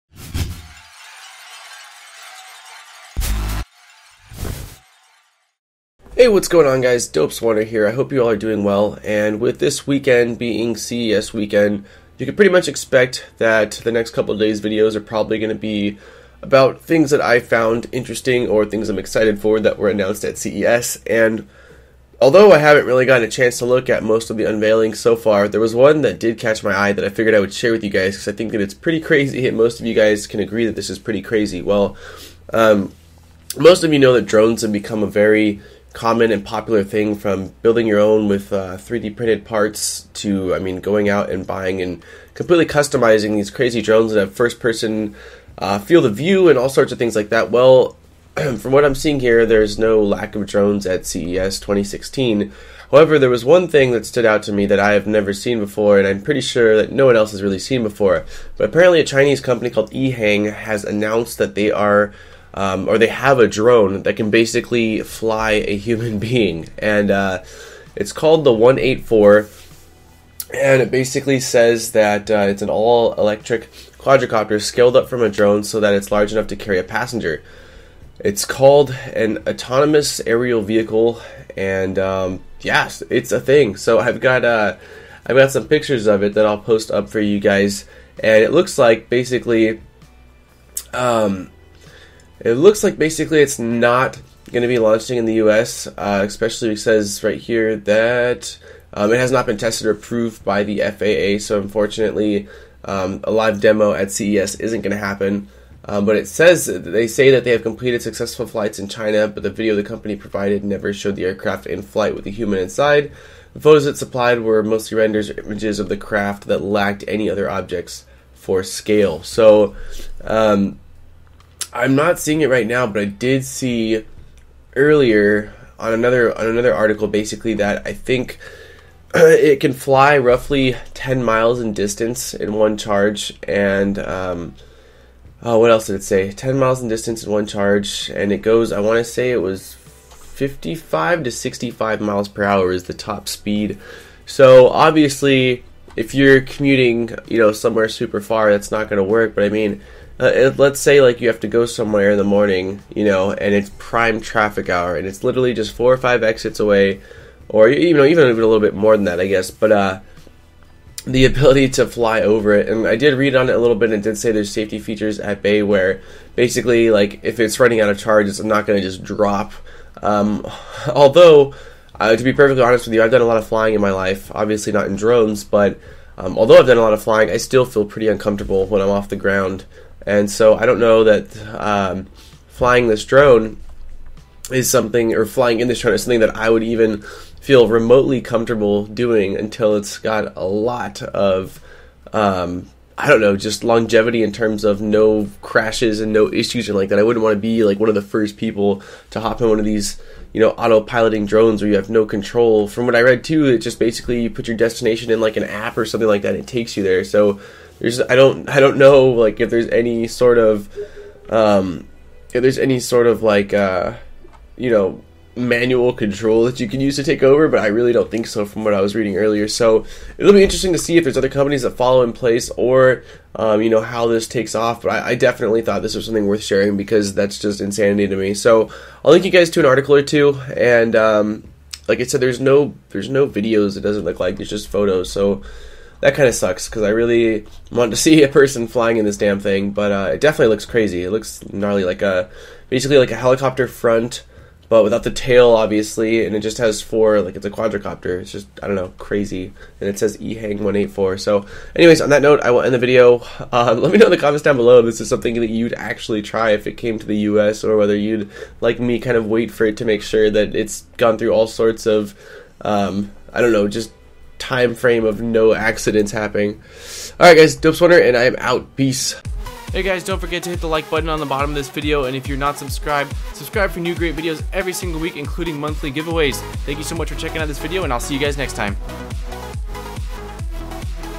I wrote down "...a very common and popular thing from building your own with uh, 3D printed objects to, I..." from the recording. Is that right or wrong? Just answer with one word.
wrong.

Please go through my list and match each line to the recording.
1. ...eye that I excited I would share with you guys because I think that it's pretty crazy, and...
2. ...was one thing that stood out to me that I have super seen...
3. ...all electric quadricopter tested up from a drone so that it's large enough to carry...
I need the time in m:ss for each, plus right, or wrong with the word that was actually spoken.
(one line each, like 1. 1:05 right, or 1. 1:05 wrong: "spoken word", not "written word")
1. 0:26 wrong: "figured", not "excited"
2. 0:53 wrong: "never", not "super"
3. 1:12 wrong: "scaled", not "tested".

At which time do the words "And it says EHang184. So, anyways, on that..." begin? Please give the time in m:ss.
4:09.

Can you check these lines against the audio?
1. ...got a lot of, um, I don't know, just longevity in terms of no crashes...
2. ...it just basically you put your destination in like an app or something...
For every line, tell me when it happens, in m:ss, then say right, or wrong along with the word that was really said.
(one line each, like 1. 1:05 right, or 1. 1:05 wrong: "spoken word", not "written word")
1. 3:09 right
2. 3:23 right.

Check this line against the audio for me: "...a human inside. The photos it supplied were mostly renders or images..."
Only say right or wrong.
right.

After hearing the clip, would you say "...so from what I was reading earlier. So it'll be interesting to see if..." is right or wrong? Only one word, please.
right.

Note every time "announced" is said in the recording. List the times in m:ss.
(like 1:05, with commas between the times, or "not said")
0:19, 1:00.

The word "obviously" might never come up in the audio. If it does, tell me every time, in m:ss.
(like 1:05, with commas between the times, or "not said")
2:24, 2:54, 4:05.